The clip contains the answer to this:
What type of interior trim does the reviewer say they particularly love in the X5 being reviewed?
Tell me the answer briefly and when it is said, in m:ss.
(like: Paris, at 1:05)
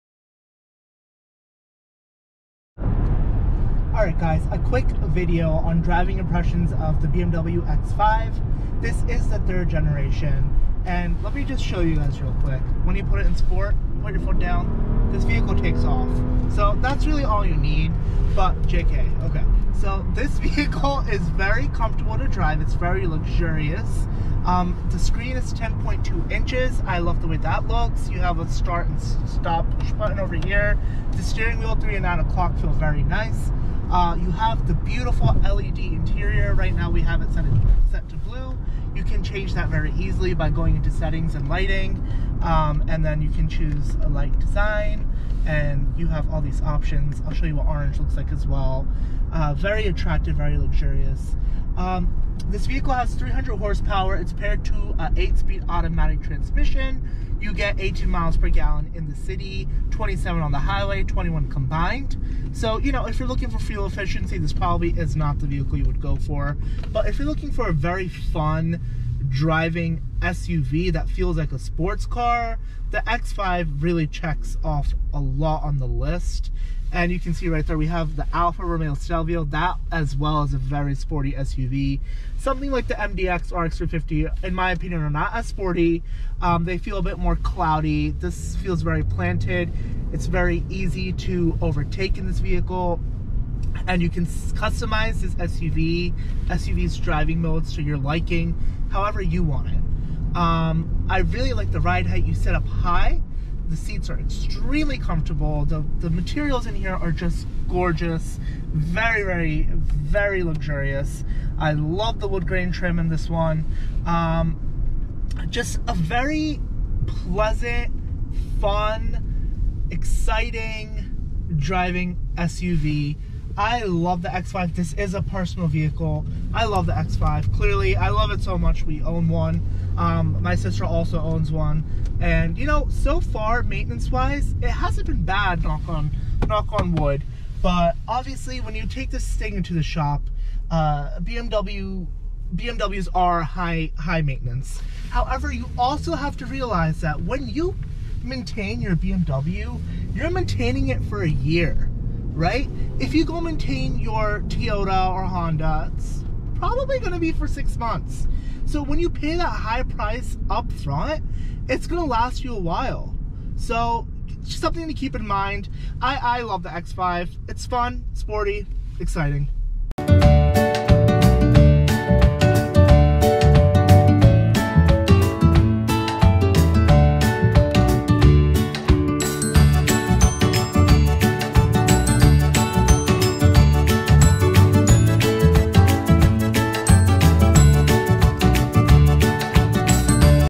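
wood grain, at 1:52.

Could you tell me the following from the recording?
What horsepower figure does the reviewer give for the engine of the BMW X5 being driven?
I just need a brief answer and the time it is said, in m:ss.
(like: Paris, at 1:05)
300, at 0:53.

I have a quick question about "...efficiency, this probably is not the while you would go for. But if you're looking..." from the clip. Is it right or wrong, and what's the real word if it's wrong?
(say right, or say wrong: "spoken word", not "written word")
wrong: "vehicle", not "while".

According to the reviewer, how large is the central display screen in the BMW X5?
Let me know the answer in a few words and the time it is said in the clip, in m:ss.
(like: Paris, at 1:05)
10.2 inches, at 0:25.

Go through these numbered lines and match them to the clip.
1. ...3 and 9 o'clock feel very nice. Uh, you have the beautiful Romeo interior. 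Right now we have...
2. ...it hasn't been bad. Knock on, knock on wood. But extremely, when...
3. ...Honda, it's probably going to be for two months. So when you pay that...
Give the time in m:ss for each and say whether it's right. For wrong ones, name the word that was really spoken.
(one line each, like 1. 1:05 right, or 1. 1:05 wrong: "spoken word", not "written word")
1. 0:31 wrong: "LED", not "Romeo"
2. 2:14 wrong: "obviously", not "extremely"
3. 2:35 wrong: "six", not "two".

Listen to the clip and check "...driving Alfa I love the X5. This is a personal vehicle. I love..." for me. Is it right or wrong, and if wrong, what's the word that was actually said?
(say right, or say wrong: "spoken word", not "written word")
wrong: "SUV", not "Alfa".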